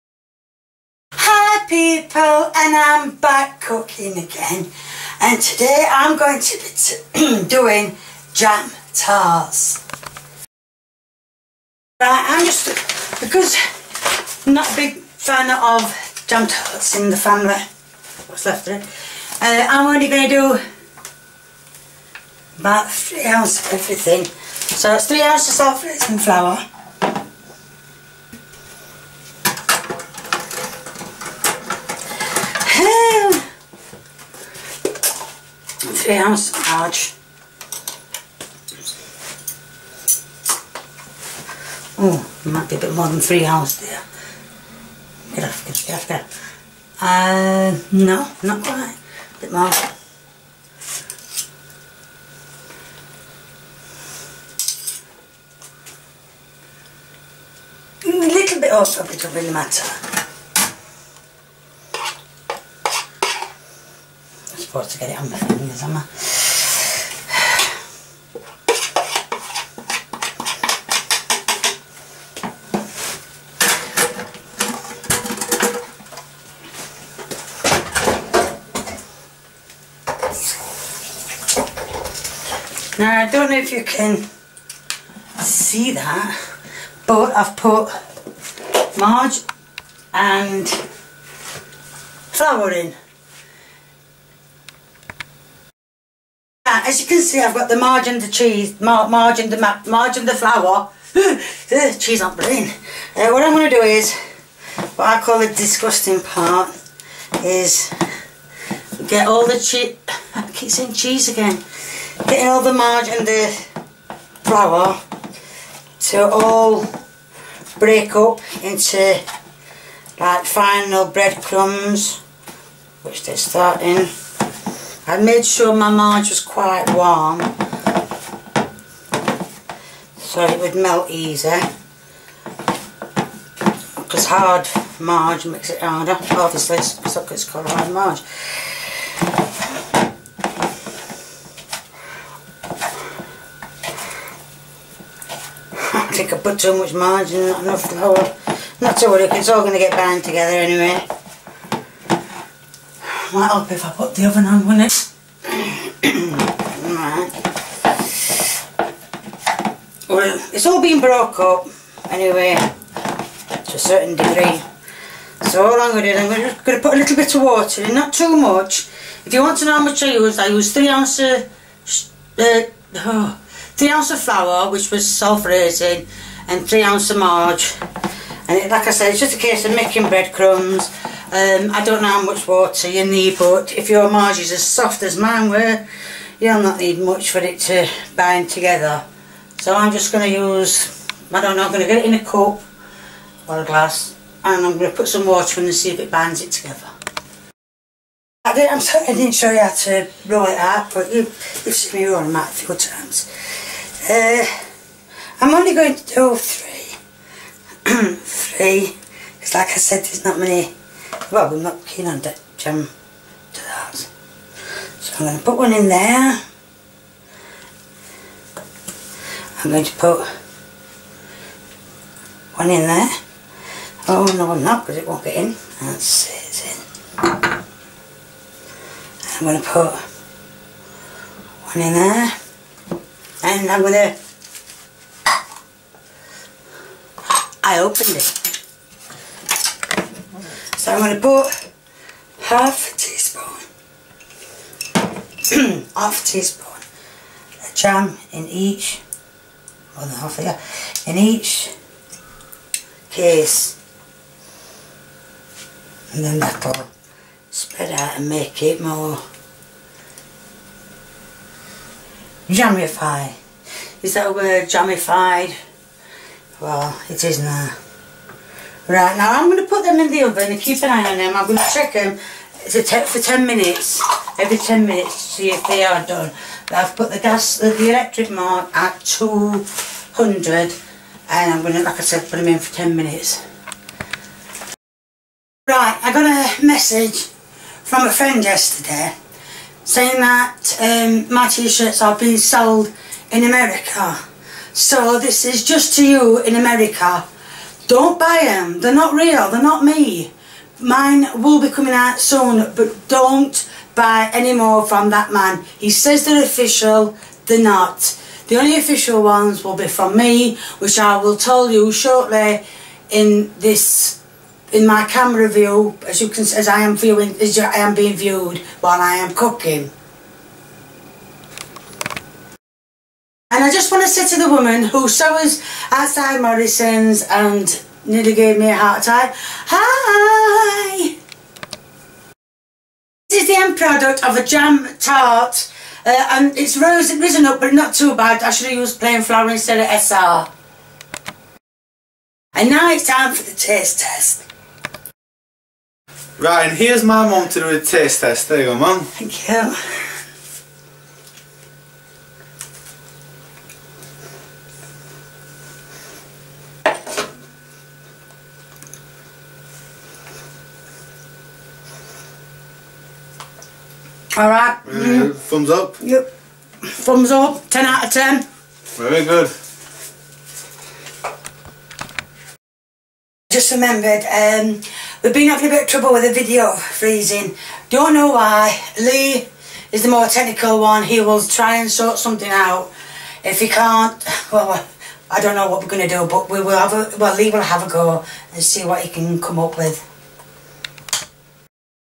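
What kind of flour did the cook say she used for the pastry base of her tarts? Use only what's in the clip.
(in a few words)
self-raising.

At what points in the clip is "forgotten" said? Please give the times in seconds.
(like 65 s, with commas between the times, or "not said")
not said.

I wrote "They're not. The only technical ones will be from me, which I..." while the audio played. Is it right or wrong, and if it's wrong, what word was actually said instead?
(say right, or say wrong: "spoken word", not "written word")
wrong: "official", not "technical".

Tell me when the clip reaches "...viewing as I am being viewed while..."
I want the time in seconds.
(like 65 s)
316 s.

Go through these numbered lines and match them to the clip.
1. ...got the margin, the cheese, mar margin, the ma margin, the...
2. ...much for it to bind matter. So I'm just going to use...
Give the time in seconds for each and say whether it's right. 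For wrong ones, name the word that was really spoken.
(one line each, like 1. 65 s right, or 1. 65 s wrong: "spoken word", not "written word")
1. 97 s right
2. 186 s wrong: "together", not "matter".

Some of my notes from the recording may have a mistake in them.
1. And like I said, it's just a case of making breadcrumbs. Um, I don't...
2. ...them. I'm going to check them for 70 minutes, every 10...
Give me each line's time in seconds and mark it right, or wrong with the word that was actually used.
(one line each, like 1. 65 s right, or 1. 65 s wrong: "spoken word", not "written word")
1. 178 s right
2. 271 s wrong: "10", not "70".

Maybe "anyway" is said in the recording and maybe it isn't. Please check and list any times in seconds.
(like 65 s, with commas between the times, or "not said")
150 s, 162 s.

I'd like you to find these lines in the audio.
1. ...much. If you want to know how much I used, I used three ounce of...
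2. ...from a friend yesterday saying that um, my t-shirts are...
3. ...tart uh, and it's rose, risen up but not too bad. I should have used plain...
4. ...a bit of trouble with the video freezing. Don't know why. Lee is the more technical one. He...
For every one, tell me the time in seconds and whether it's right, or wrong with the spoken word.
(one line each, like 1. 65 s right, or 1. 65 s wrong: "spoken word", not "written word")
1. 168 s right
2. 287 s right
3. 334 s right
4. 375 s right.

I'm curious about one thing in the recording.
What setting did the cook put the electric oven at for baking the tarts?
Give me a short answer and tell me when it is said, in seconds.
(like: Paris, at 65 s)
200, at 279 s.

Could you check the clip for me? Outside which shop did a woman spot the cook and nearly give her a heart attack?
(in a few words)
Morrison's.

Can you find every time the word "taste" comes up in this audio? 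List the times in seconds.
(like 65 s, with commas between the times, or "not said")
343 s, 347 s.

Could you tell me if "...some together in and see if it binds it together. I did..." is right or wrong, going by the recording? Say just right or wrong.
wrong.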